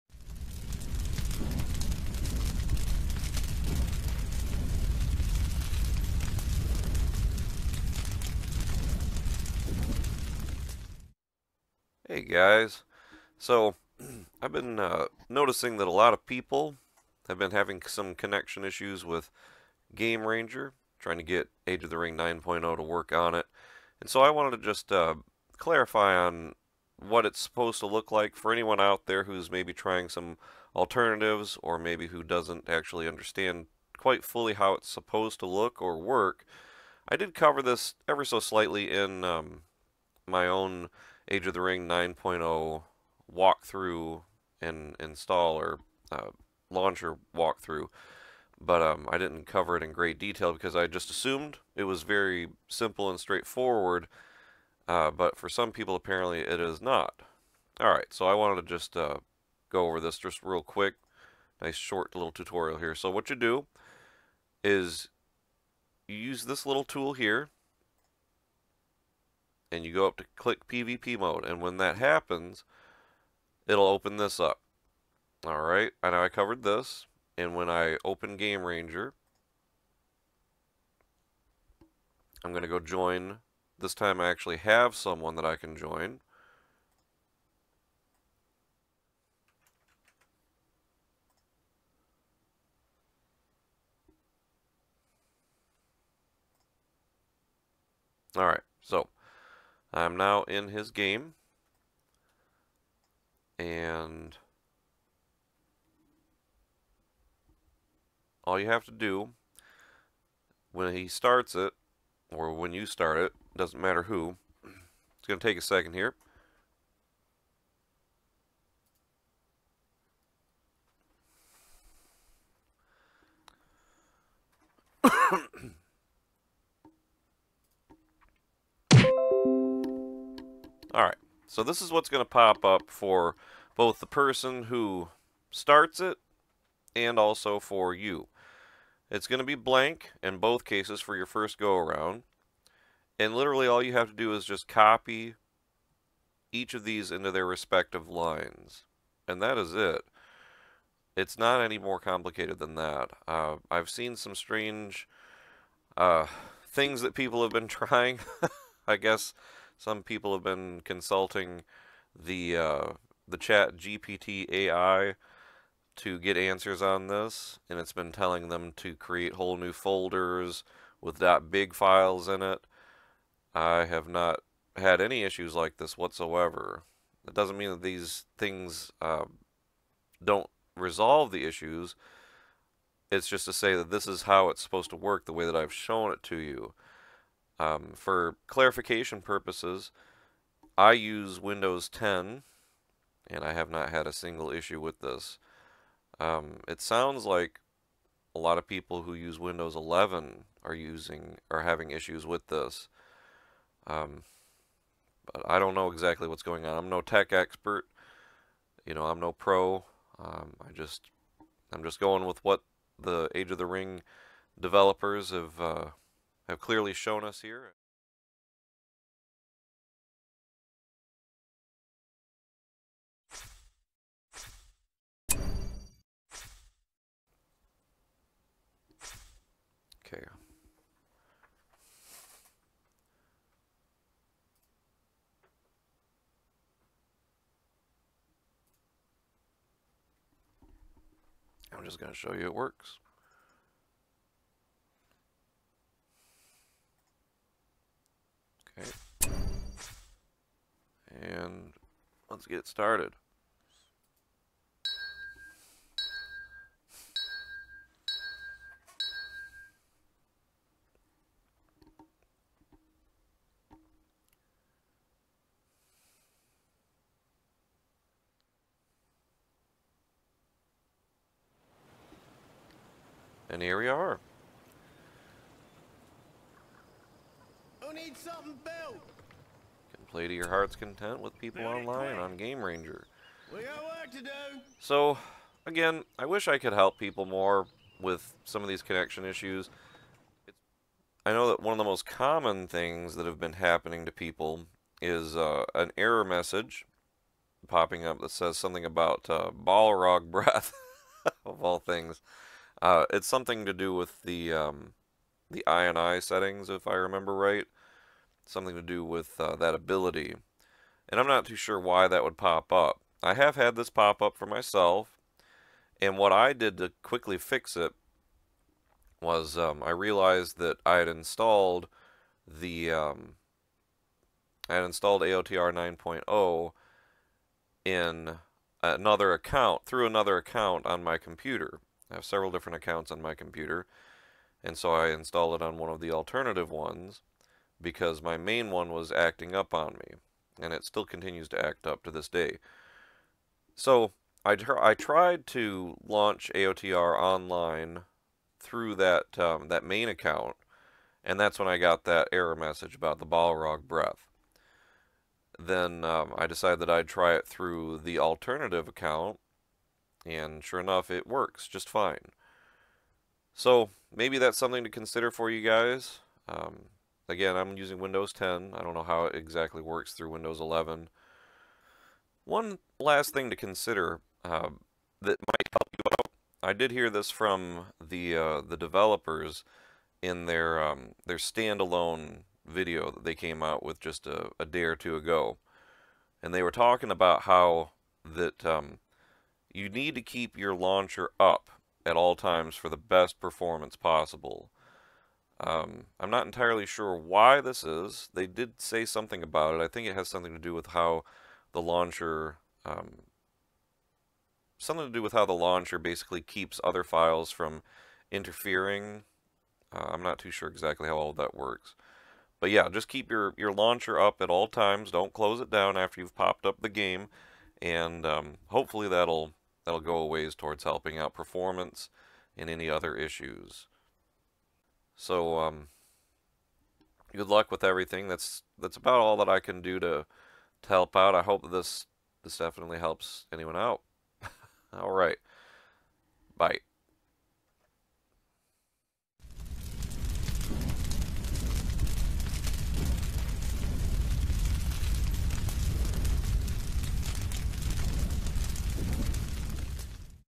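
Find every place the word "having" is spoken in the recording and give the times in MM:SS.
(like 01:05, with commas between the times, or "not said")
00:17, 03:21.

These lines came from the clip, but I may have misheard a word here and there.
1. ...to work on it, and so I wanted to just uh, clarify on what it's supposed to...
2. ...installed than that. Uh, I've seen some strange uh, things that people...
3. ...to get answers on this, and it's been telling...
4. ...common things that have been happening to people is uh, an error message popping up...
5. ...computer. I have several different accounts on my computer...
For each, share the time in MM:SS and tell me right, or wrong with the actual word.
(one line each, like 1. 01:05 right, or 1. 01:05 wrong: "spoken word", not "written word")
1. 00:22 right
2. 02:31 wrong: "complicated", not "installed"
3. 02:45 right
4. 04:52 right
5. 05:31 right.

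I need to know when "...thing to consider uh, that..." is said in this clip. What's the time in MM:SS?
06:13.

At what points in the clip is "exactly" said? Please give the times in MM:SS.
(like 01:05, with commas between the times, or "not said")
03:25, 06:09, 06:50.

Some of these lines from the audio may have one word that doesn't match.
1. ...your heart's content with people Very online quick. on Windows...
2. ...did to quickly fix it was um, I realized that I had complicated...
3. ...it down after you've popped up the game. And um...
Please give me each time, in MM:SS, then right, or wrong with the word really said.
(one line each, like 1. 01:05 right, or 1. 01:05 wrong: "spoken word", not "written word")
1. 04:40 wrong: "Game", not "Windows"
2. 05:16 wrong: "installed", not "complicated"
3. 06:55 right.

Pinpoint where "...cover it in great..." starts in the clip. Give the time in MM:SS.
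00:49.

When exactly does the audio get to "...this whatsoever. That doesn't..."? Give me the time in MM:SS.
02:55.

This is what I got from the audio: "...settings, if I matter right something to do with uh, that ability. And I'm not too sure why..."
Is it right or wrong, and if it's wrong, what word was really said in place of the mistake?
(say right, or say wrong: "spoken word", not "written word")
wrong: "remember", not "matter".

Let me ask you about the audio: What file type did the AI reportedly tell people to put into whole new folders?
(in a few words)
.big files.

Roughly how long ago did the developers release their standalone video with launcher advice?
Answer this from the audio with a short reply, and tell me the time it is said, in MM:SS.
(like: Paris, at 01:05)
a day or two, at 06:24.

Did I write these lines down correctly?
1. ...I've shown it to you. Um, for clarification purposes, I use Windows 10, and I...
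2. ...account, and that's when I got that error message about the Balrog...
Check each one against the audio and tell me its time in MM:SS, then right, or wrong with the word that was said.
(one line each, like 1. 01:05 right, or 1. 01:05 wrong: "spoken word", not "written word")
1. 03:05 right
2. 05:50 right.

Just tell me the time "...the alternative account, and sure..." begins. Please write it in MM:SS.
05:58.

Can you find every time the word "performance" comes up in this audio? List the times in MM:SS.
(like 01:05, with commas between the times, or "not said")
06:33, 07:01.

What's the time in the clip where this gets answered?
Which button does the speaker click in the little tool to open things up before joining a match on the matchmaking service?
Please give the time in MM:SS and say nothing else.
01:10.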